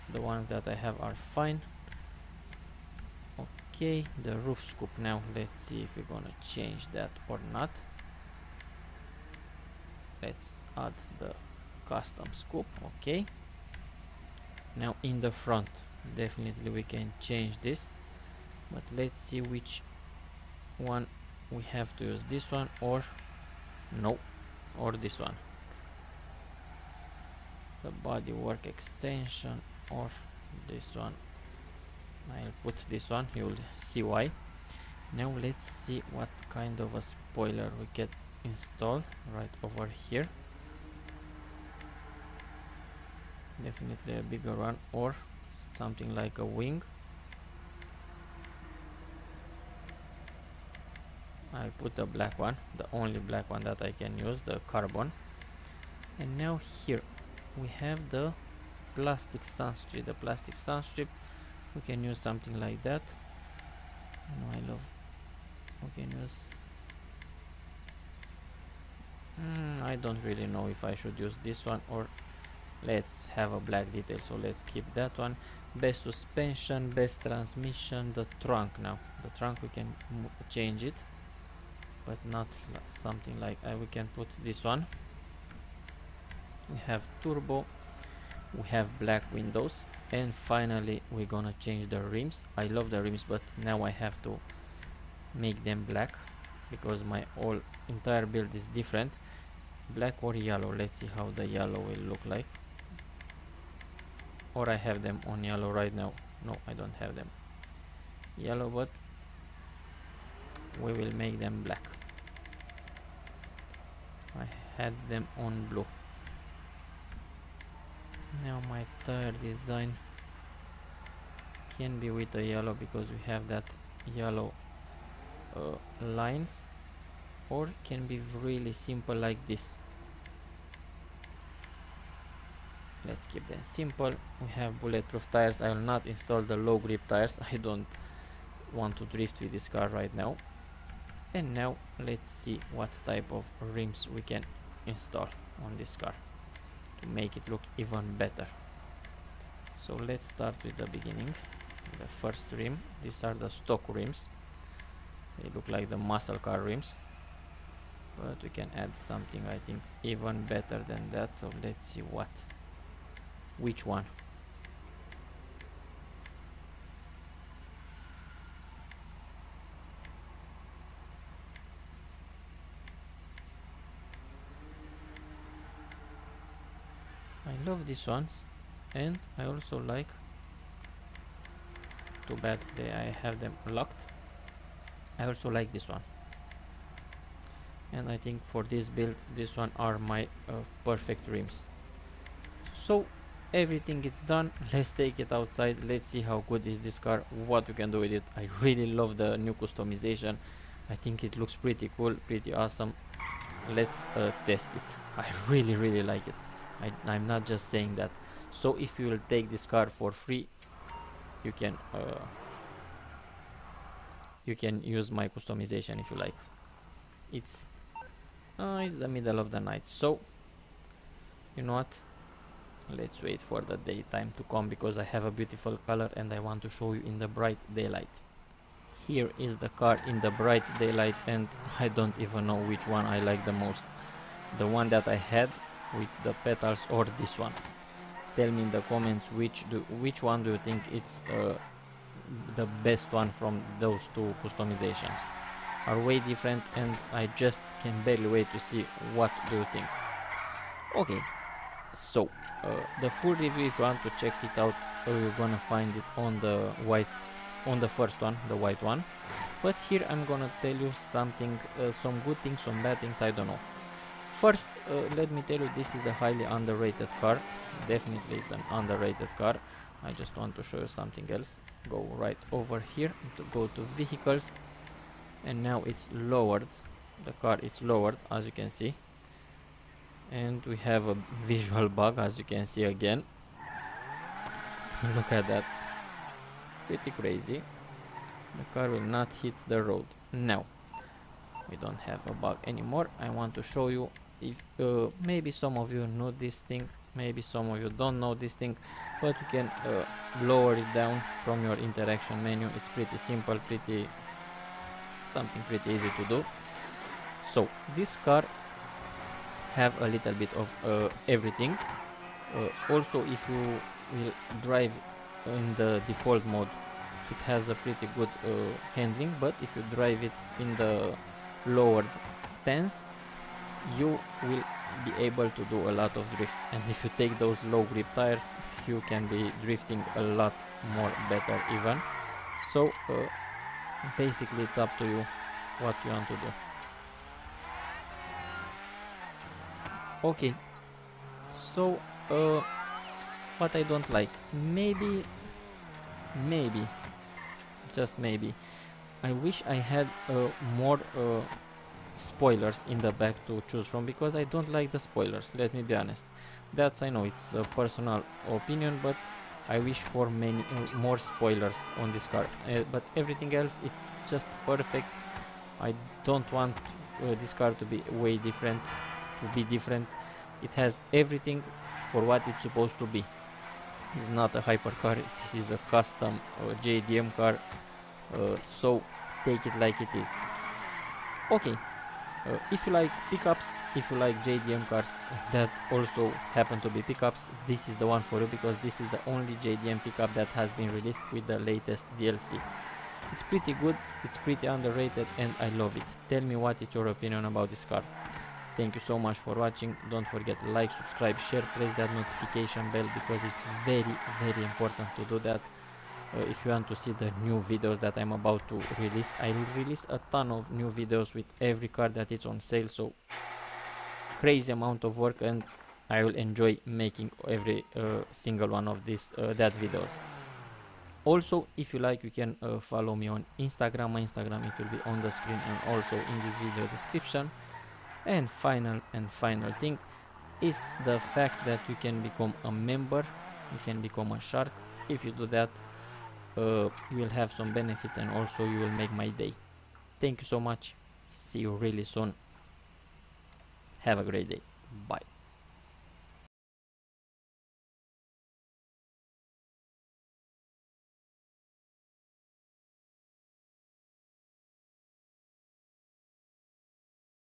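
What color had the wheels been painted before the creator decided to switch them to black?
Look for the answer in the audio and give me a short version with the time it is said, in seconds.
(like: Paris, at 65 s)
Blue, at 115 s.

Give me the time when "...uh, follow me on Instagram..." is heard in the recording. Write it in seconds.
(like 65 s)
422 s.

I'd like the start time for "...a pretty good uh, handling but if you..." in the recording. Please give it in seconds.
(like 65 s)
317 s.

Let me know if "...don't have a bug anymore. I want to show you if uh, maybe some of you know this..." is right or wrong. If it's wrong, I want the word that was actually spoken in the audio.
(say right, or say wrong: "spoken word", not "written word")
right.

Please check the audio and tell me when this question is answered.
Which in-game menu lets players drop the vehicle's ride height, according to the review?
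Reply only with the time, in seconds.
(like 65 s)
301 s.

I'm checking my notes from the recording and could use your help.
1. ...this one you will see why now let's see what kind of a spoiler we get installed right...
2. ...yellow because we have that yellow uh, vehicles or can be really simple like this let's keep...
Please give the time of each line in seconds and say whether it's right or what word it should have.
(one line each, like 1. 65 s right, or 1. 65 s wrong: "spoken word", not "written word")
1. 32 s right
2. 122 s wrong: "lines", not "vehicles".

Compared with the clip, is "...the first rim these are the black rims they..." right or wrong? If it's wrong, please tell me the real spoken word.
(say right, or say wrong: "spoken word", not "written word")
wrong: "stock", not "black".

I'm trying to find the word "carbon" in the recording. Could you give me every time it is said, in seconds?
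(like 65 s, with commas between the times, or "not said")
54 s.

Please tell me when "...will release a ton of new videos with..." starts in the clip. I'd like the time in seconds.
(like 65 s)
409 s.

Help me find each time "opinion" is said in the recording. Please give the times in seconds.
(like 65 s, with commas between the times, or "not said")
358 s, 397 s.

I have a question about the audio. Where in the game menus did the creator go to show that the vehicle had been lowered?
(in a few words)
Vehicles.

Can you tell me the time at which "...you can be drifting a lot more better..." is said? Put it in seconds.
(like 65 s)
328 s.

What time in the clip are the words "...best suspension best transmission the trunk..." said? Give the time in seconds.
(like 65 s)
75 s.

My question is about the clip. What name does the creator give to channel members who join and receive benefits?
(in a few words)
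Shark.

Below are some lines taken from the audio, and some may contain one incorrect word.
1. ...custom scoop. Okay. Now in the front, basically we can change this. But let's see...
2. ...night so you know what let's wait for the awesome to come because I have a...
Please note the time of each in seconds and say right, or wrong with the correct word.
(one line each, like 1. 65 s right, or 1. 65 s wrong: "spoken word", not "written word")
1. 11 s wrong: "definitely", not "basically"
2. 219 s wrong: "daytime", not "awesome".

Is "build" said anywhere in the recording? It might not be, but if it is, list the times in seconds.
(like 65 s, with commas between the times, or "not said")
98 s, 188 s.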